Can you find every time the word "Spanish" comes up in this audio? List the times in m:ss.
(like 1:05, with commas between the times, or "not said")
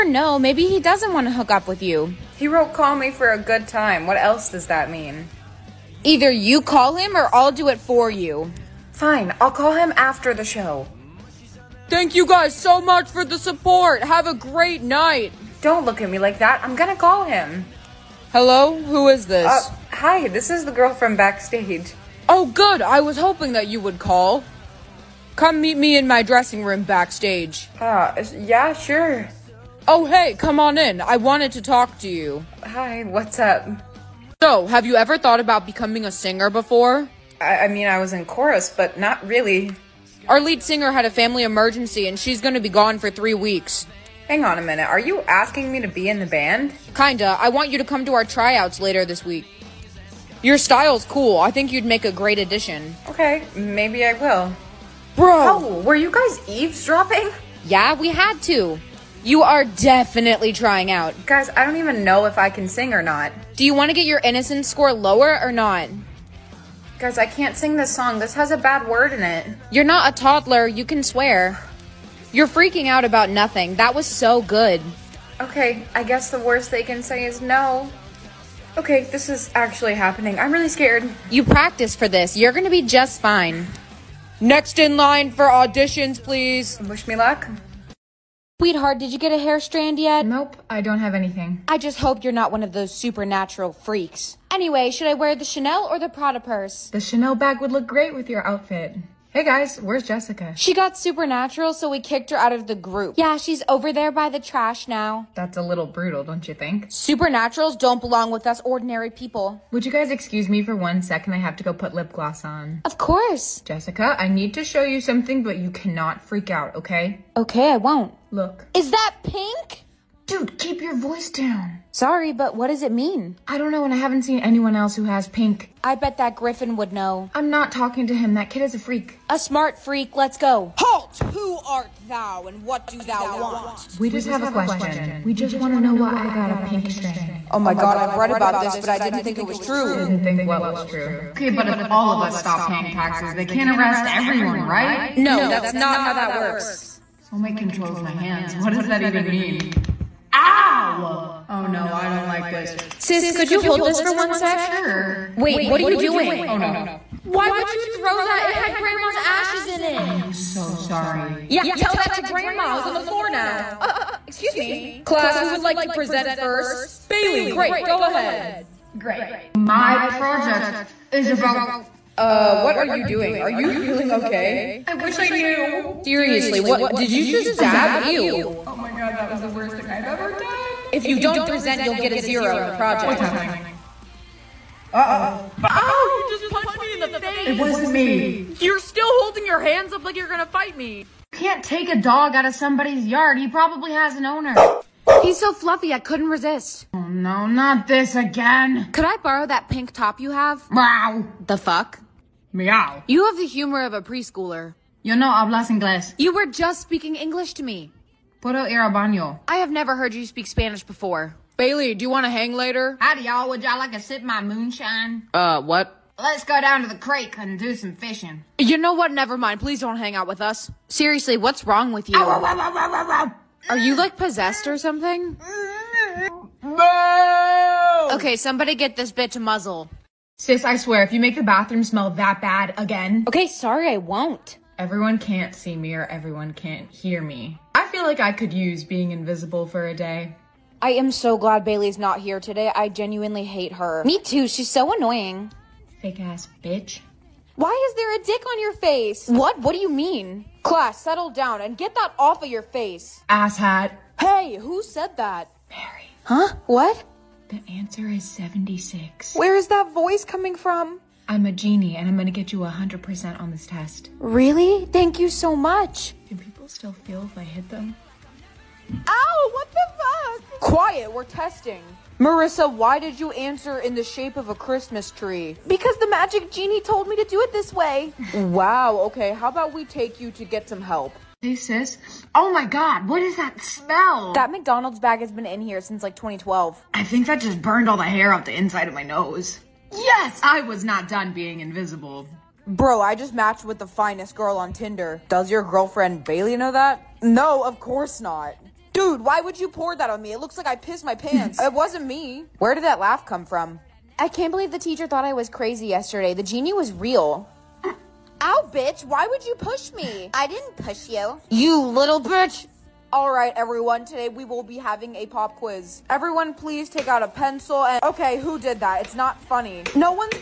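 3:30.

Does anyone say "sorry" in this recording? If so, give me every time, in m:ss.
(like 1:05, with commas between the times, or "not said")
2:01, 2:40, 3:53.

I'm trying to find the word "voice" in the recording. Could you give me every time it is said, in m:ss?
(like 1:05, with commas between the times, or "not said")
2:00, 4:19.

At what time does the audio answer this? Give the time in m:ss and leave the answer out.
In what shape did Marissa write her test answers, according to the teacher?
4:34.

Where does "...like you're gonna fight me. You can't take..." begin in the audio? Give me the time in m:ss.
3:10.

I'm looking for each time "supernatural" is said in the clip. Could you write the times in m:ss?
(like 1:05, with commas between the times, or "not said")
1:32, 1:40, 1:46.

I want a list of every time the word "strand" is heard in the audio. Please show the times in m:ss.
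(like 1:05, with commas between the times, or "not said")
1:29, 2:16.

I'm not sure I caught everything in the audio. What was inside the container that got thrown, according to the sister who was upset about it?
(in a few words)
Grandma's ashes.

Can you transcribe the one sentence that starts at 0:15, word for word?
Don't look at me like that.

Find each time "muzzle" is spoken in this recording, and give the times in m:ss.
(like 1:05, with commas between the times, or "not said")
3:49.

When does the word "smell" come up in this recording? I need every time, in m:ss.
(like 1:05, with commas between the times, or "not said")
3:51, 4:43.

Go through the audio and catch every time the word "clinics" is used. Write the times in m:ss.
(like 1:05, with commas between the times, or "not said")
not said.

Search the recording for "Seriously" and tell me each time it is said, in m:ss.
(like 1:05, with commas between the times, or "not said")
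2:56, 3:40.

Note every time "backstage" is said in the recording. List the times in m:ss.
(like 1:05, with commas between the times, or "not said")
0:21, 0:26.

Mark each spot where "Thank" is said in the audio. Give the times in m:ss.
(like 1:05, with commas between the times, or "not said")
0:11, 4:24.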